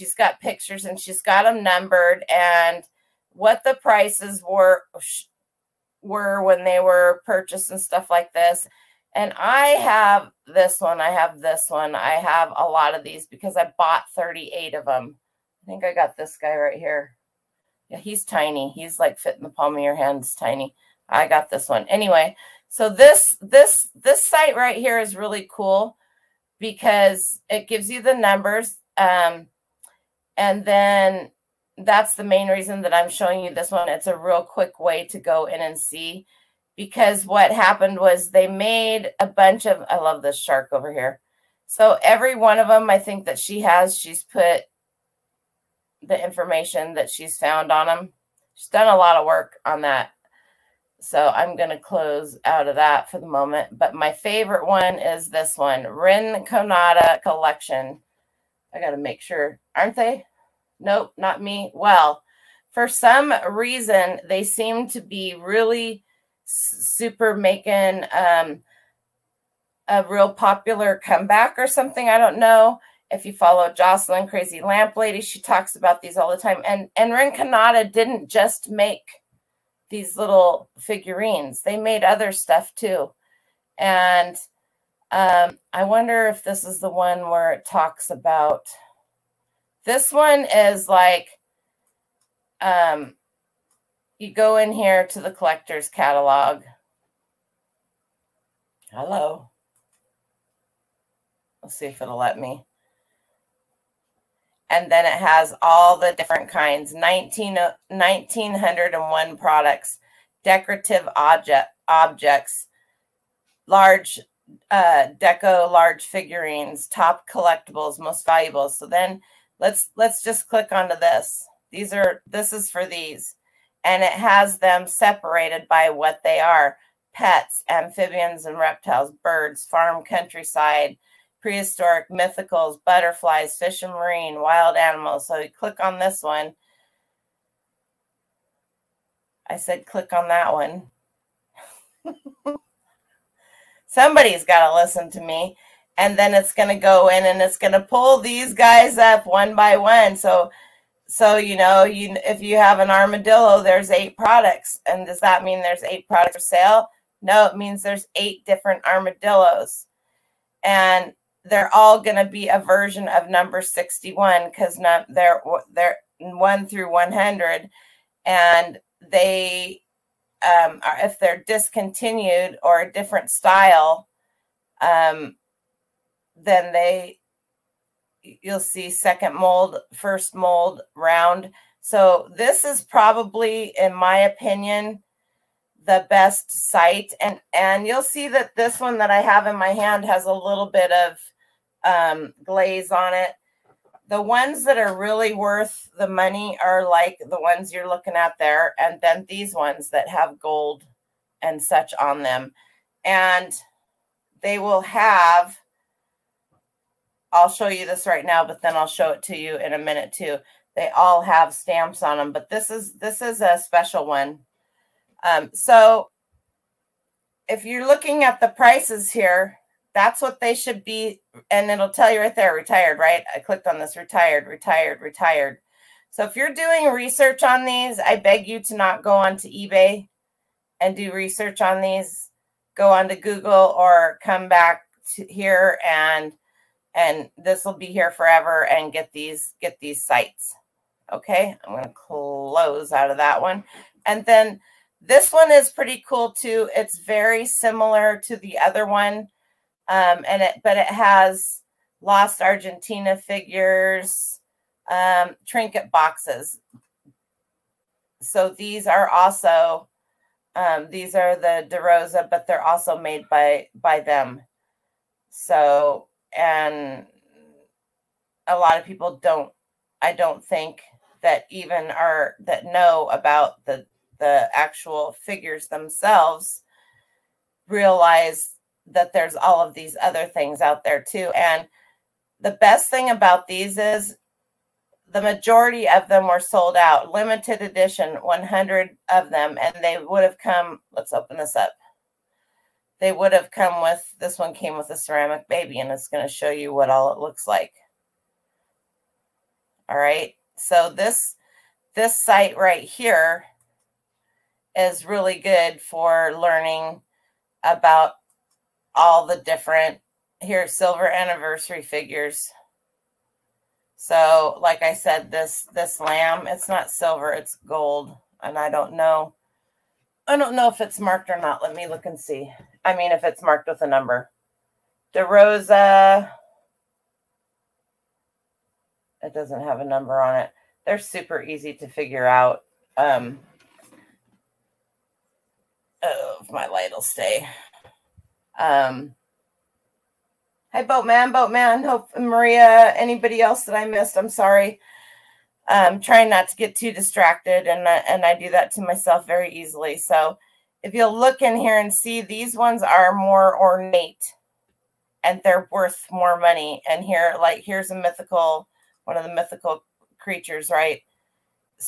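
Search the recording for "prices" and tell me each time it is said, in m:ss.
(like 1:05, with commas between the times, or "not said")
0:03, 3:38.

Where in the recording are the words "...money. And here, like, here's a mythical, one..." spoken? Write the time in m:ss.
5:56.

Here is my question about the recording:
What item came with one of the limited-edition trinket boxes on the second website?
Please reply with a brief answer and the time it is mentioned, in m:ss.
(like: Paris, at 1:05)
a ceramic baby, at 4:54.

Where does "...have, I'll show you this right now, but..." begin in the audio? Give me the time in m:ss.
3:24.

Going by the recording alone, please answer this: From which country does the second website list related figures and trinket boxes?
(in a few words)
Argentina.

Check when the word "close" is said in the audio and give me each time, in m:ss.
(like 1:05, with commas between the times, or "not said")
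0:51, 4:01.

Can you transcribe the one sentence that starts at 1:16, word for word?
And, and Rinconada didn't just make – these little figurines.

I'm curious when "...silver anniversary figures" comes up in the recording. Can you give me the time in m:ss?
5:10.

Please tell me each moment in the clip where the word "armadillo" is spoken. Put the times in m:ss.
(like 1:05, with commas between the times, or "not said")
2:32, 2:38.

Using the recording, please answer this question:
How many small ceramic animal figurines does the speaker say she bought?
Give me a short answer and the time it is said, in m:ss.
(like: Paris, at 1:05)
38, at 0:14.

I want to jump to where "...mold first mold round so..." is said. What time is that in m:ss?
2:59.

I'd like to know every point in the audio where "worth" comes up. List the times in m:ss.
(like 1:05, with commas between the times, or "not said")
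3:15, 5:55.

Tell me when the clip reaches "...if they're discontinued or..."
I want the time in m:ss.
2:51.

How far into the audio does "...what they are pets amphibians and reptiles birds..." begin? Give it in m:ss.
2:05.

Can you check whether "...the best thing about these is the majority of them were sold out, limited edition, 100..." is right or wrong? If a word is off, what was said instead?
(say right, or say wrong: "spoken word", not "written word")
right.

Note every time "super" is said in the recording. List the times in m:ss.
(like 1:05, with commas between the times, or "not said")
1:06, 5:30.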